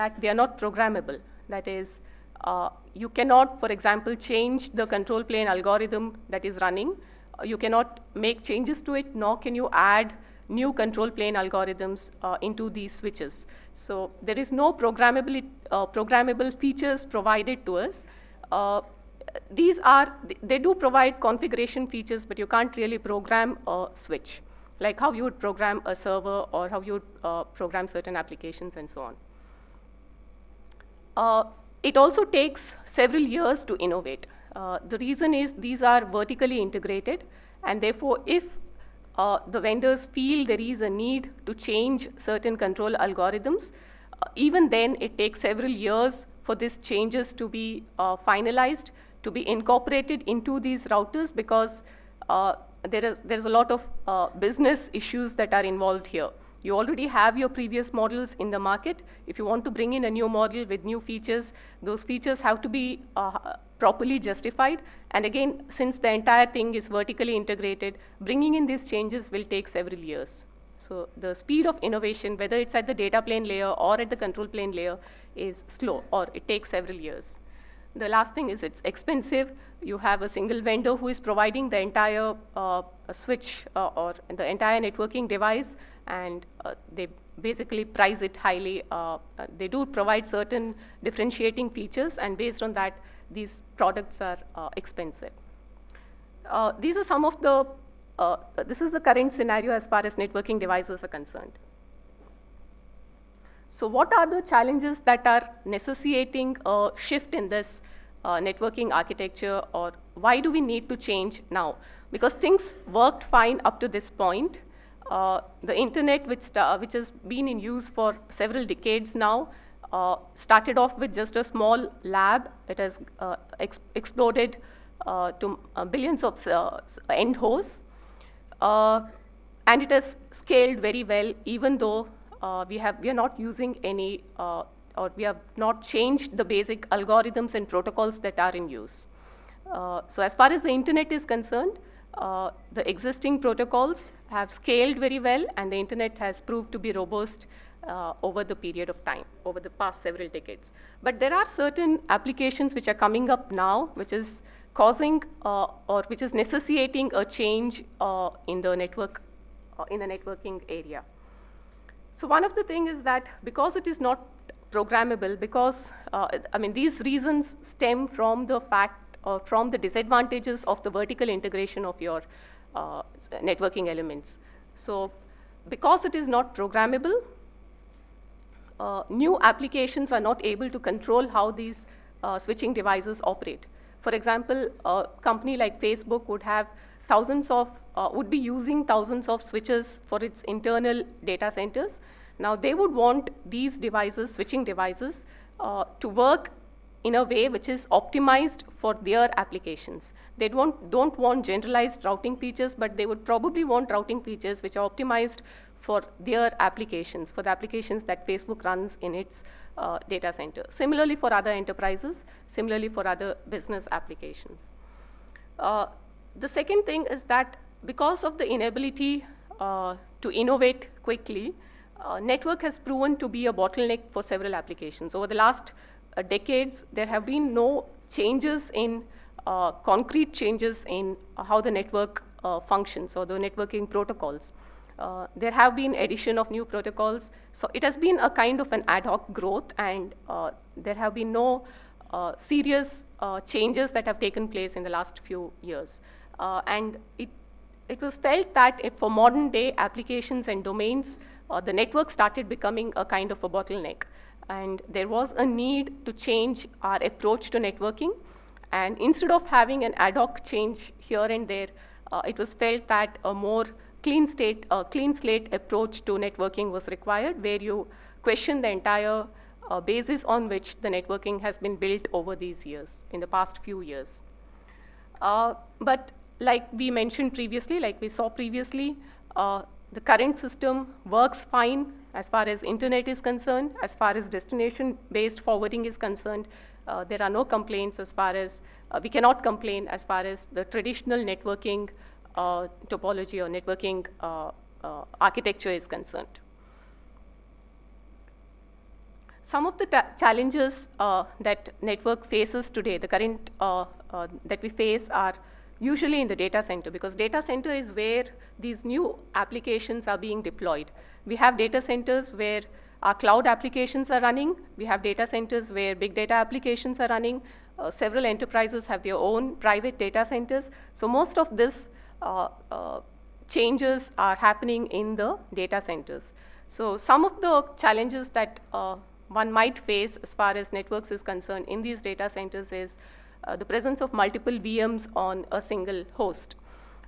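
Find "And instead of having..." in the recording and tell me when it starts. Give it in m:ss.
4:18.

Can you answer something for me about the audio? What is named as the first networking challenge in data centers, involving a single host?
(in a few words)
multiple VMs.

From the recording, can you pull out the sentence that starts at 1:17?
The last thing is it's expensive.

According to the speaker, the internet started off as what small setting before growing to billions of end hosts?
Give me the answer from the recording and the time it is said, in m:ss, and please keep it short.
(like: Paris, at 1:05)
a small lab, at 2:01.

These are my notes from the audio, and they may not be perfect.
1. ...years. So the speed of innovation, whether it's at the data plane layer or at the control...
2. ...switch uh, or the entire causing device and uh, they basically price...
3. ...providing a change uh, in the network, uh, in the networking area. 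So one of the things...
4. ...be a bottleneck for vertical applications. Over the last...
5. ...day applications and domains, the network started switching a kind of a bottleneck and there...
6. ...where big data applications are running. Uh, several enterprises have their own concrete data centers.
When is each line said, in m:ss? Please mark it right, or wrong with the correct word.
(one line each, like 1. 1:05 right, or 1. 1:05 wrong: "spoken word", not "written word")
1. 1:09 right
2. 1:23 wrong: "networking", not "causing"
3. 2:36 wrong: "necessitating", not "providing"
4. 3:43 wrong: "several", not "vertical"
5. 4:09 wrong: "becoming", not "switching"
6. 5:15 wrong: "private", not "concrete".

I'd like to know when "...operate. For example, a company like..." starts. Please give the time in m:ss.
3:03.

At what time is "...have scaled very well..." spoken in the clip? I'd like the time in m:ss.
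2:24.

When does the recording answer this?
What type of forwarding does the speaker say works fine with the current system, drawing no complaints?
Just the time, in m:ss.
4:44.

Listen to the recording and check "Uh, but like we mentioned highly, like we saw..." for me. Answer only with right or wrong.
wrong.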